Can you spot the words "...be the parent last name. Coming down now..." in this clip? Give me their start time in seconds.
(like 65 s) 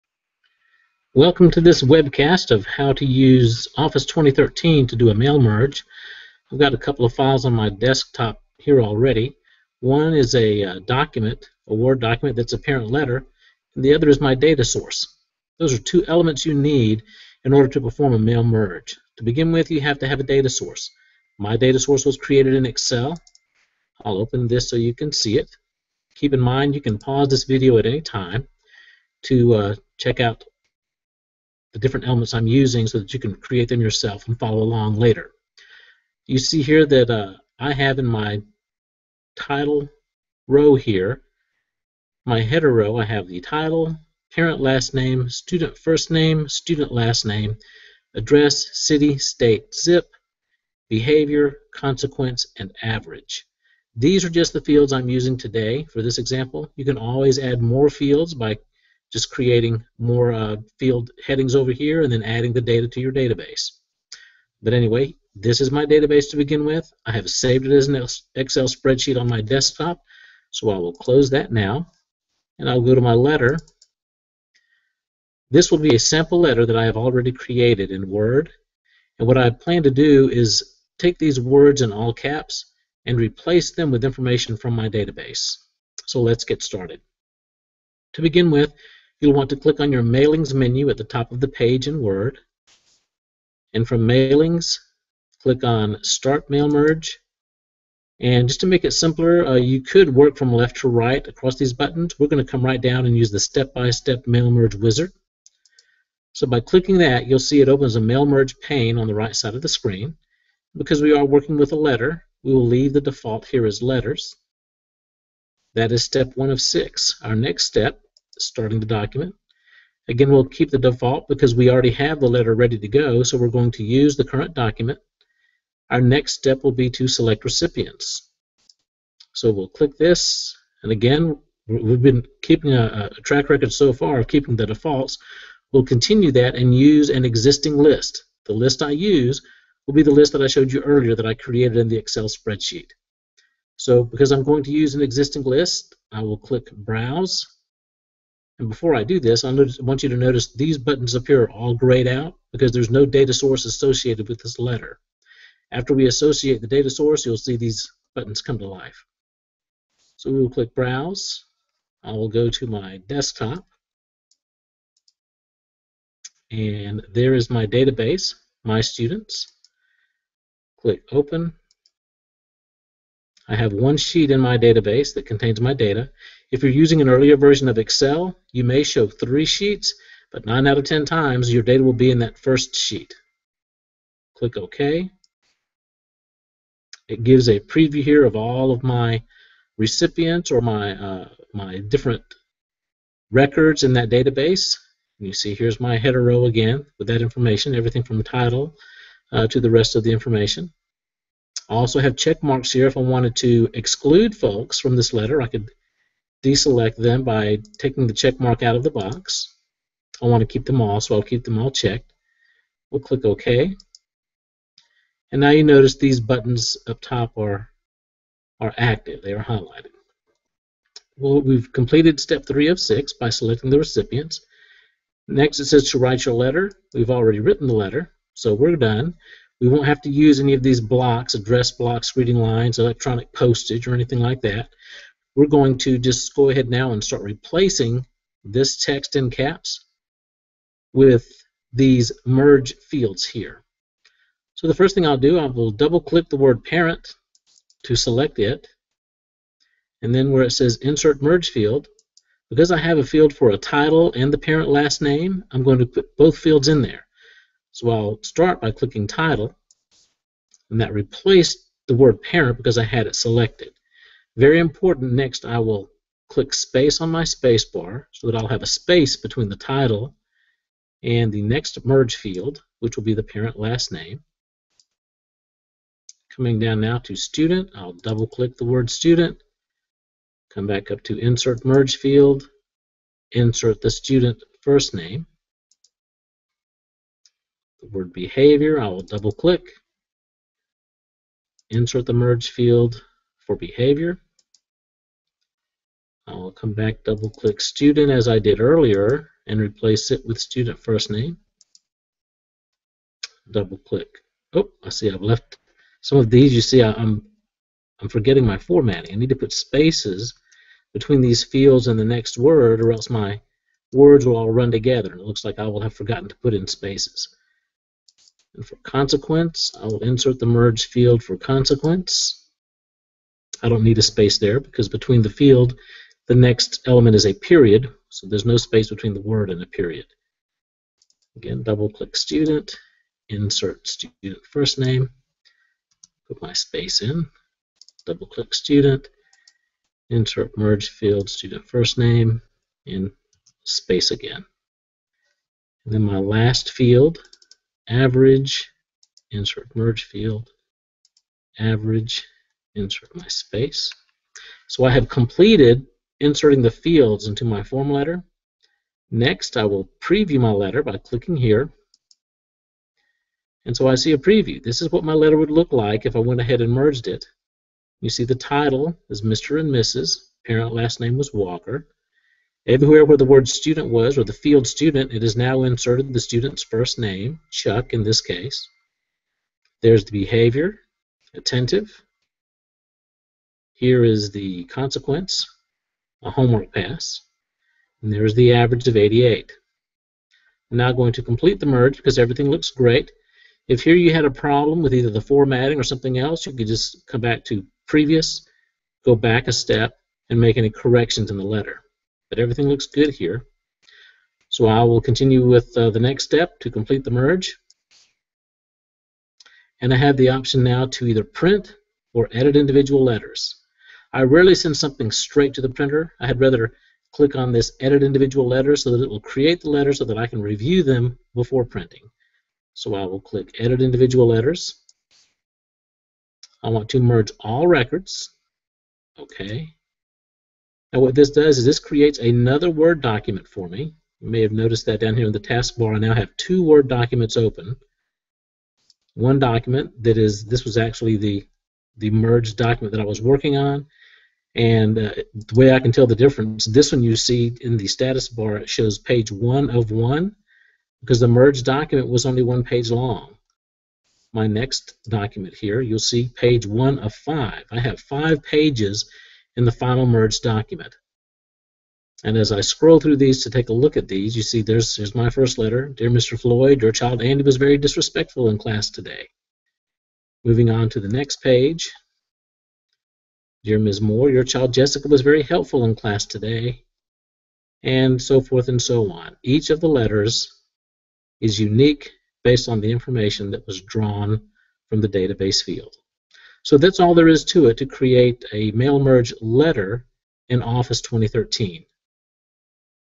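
273 s.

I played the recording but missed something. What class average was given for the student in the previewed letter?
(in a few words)
88.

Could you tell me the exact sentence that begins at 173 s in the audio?
I have one sheet in my database that contains my data.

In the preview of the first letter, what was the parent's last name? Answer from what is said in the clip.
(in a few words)
Walker.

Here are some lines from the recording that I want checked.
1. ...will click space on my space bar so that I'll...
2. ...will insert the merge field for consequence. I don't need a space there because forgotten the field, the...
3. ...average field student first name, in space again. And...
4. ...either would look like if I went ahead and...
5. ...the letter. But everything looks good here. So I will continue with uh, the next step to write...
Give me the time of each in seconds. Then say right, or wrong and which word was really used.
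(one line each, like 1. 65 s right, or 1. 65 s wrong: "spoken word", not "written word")
1. 265 s right
2. 319 s wrong: "between", not "forgotten"
3. 340 s wrong: "merge", not "average"
4. 365 s wrong: "letter", not "either"
5. 401 s wrong: "complete", not "write".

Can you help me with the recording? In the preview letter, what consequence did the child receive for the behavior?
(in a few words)
a homework pass.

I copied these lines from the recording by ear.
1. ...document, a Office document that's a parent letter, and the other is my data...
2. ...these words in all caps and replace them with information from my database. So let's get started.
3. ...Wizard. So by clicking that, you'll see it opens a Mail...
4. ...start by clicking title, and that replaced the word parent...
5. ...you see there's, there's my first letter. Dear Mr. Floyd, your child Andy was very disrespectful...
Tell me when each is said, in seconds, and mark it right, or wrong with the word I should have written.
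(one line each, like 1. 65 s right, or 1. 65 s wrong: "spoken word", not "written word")
1. 10 s wrong: "Word", not "Office"
2. 81 s right
3. 104 s right
4. 258 s right
5. 464 s right.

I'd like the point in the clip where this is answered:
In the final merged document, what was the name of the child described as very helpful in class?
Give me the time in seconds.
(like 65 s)
474 s.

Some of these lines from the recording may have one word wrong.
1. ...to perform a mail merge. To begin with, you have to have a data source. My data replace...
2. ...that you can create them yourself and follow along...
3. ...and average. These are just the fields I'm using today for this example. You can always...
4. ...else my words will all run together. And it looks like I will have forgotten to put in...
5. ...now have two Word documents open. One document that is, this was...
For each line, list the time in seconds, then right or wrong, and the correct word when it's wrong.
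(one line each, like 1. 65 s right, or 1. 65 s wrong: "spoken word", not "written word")
1. 17 s wrong: "source", not "replace"
2. 32 s right
3. 52 s right
4. 312 s right
5. 435 s right.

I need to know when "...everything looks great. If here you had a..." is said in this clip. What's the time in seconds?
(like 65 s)
392 s.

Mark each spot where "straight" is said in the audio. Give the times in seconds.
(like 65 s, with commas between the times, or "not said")
415 s.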